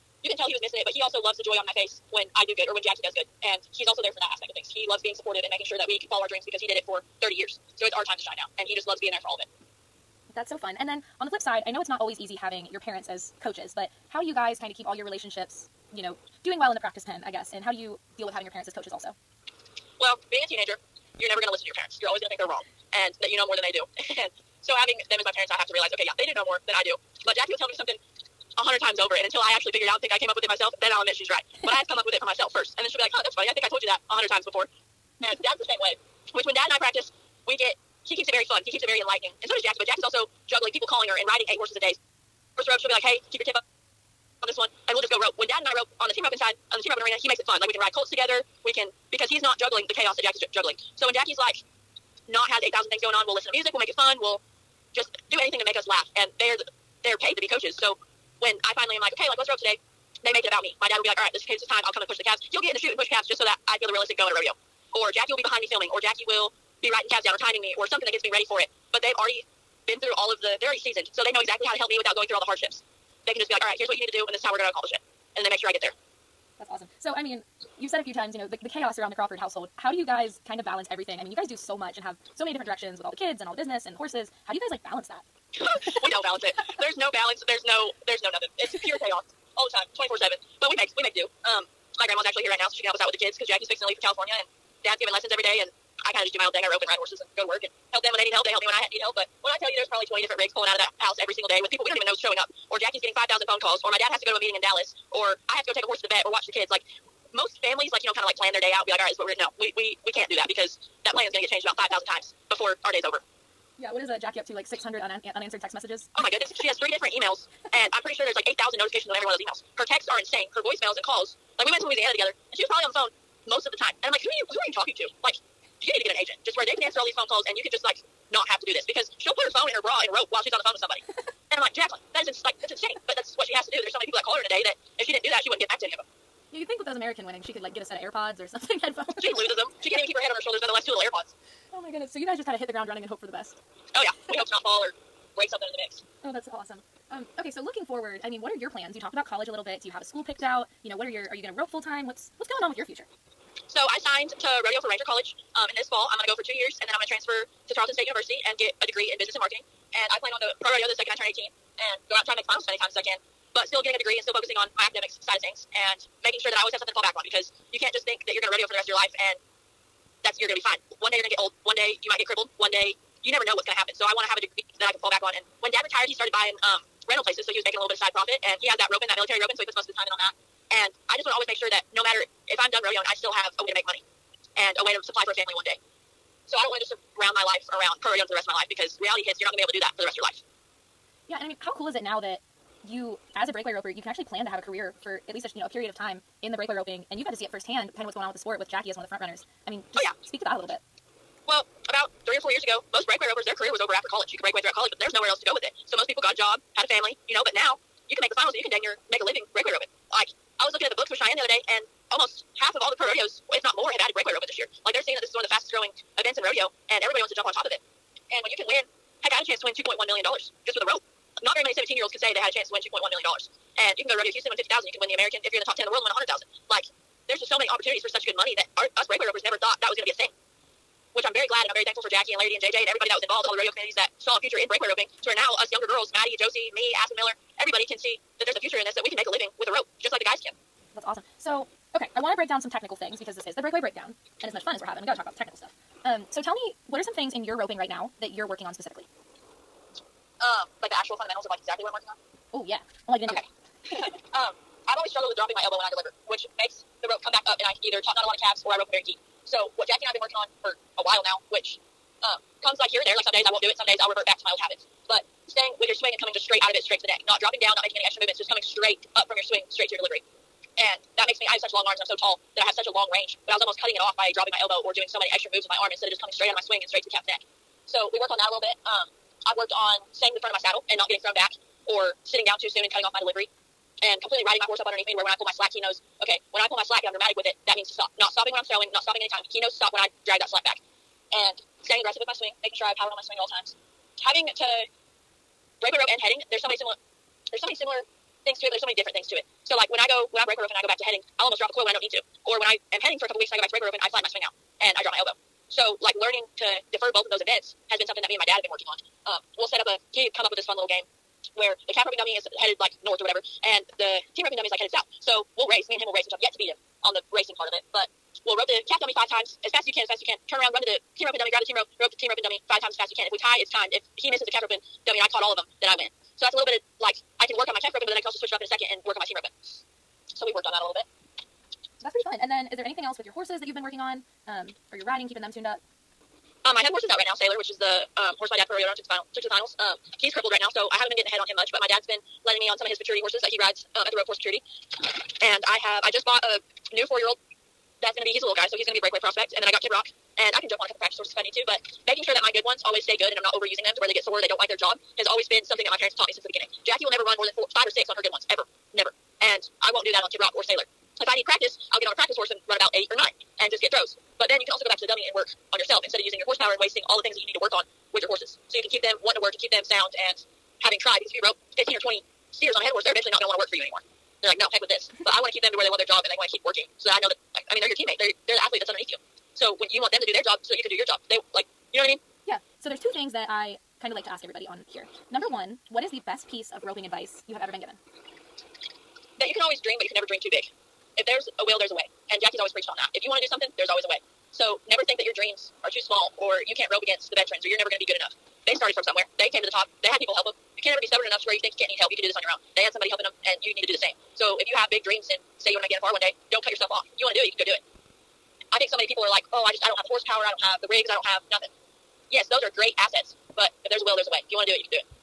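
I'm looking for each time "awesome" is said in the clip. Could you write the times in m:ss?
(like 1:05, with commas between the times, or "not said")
1:16, 2:26, 4:01.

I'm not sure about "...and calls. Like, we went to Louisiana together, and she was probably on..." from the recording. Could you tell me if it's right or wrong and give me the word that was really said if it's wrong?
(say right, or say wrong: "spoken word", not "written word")
right.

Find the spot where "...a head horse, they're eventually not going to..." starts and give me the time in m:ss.
6:12.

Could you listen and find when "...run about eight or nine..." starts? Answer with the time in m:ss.
6:02.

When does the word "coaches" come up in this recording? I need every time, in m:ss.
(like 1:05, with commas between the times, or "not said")
0:13, 0:18, 0:57.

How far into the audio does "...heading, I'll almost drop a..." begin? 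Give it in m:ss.
5:01.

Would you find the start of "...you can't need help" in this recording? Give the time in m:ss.
6:41.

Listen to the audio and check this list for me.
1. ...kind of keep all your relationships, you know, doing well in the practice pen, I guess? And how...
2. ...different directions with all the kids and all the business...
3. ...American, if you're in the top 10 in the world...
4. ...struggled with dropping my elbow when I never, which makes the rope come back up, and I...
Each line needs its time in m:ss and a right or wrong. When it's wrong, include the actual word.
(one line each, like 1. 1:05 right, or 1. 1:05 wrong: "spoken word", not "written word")
1. 0:14 right
2. 1:22 right
3. 3:45 right
4. 4:15 wrong: "deliver", not "never".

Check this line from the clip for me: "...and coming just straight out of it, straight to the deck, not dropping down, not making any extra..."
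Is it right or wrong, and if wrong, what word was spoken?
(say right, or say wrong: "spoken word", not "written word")
right.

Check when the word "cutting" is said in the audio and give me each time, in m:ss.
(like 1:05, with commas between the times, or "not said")
4:33, 4:42.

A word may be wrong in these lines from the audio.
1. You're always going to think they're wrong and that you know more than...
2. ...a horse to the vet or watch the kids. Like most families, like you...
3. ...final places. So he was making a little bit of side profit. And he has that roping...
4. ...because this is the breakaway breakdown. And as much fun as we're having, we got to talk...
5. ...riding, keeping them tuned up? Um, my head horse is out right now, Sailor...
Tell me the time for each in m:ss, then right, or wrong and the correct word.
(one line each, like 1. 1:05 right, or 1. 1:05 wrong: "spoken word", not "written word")
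1. 0:22 right
2. 1:45 right
3. 2:57 wrong: "rental", not "final"
4. 4:03 right
5. 5:35 right.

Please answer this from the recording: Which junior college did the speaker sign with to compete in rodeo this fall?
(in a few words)
Ranger College.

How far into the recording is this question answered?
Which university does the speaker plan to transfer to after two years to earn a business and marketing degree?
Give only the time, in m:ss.
2:37.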